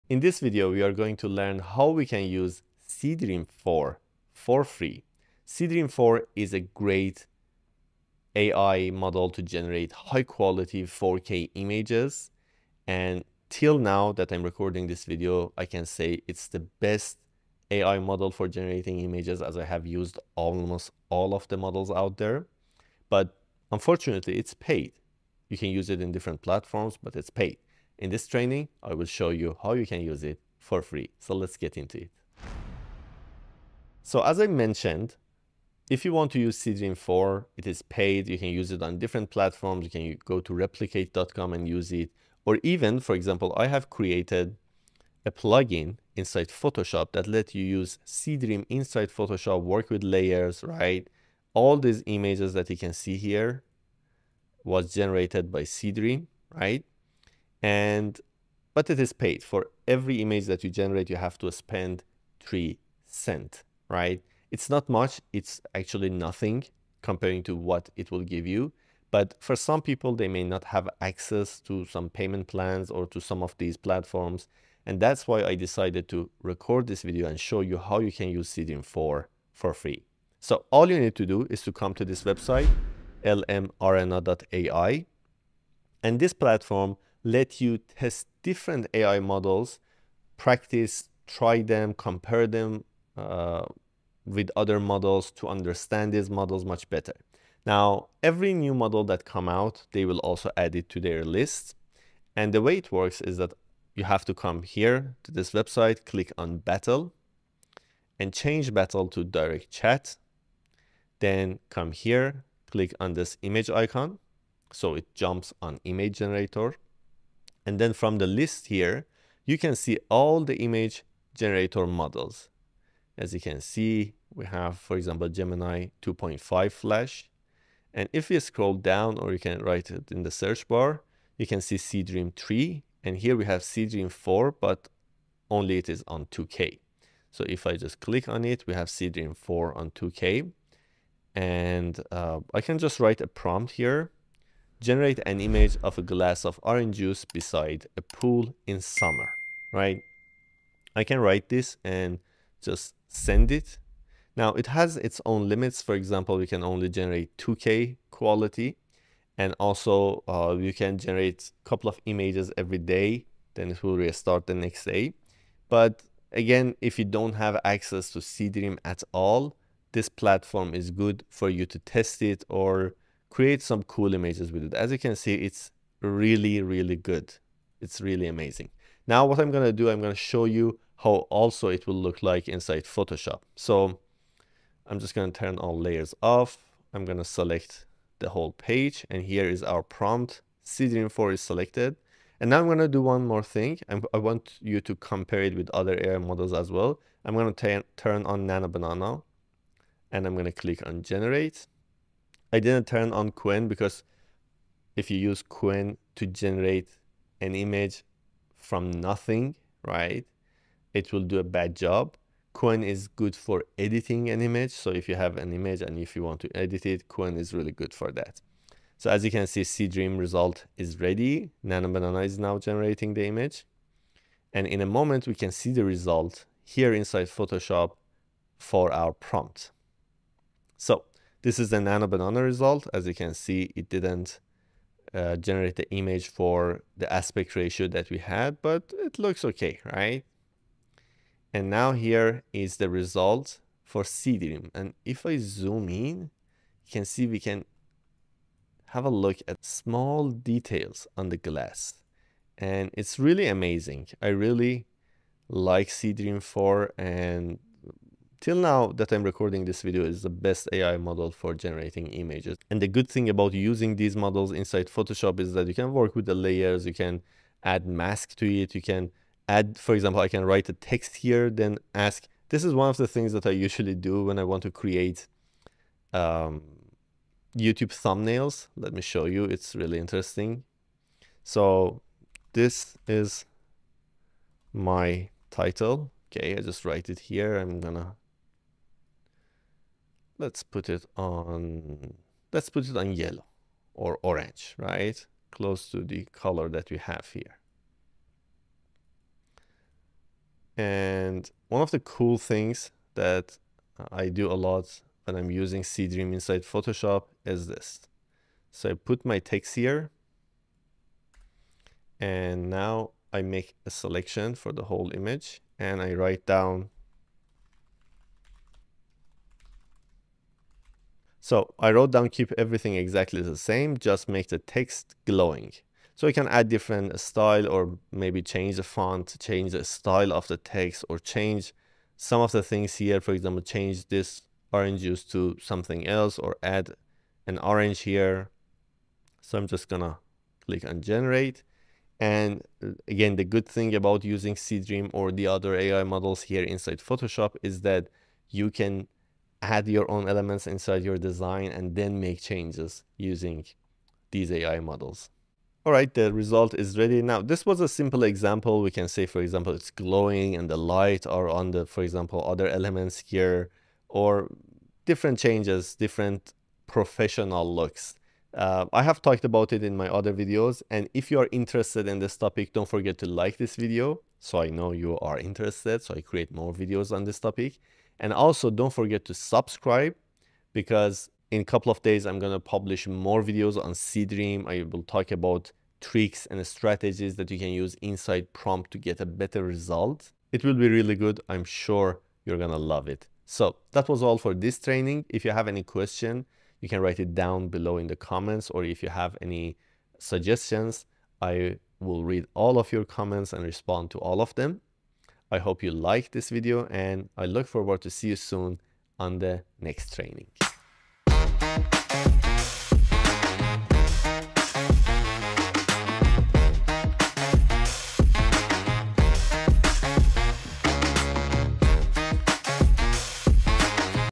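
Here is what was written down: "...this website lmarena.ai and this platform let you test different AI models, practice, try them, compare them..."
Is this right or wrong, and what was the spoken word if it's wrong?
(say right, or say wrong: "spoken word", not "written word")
right.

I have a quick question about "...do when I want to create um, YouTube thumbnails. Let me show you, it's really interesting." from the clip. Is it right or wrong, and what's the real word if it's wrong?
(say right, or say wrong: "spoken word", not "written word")
right.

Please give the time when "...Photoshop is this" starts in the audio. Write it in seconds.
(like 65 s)
306 s.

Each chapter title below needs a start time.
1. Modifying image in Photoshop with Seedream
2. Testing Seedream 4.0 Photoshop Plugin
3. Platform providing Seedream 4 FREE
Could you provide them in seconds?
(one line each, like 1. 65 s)
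1. 272 s
2. 182 s
3. 79 s.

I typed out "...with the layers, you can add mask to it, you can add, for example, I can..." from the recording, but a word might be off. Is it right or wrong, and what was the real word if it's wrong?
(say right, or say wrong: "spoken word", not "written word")
right.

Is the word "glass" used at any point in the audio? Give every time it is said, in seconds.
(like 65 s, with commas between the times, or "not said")
146 s, 251 s.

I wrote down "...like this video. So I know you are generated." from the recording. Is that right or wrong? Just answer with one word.
wrong.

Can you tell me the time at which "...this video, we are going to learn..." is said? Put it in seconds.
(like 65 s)
0 s.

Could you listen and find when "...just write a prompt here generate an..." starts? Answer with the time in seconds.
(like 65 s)
142 s.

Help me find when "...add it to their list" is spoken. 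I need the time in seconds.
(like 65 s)
100 s.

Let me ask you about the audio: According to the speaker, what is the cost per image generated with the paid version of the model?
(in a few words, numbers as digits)
3 cents.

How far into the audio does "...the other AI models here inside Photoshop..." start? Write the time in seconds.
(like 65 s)
345 s.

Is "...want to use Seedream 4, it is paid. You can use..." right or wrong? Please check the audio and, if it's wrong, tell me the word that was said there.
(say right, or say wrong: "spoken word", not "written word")
right.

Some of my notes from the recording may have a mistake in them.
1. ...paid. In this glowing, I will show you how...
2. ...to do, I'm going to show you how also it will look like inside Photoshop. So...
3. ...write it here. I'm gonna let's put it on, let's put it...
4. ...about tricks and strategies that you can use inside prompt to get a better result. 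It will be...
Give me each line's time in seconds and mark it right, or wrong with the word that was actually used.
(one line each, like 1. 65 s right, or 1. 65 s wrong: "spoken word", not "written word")
1. 27 s wrong: "training", not "glowing"
2. 179 s right
3. 286 s right
4. 385 s right.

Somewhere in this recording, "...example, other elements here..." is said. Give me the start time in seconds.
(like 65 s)
362 s.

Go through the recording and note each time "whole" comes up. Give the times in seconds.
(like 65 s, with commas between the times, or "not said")
188 s, 314 s.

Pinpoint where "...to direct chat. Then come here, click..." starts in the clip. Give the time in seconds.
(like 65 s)
109 s.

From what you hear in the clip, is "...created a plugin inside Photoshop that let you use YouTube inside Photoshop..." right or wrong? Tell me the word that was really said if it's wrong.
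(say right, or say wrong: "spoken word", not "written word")
wrong: "Seedream", not "YouTube".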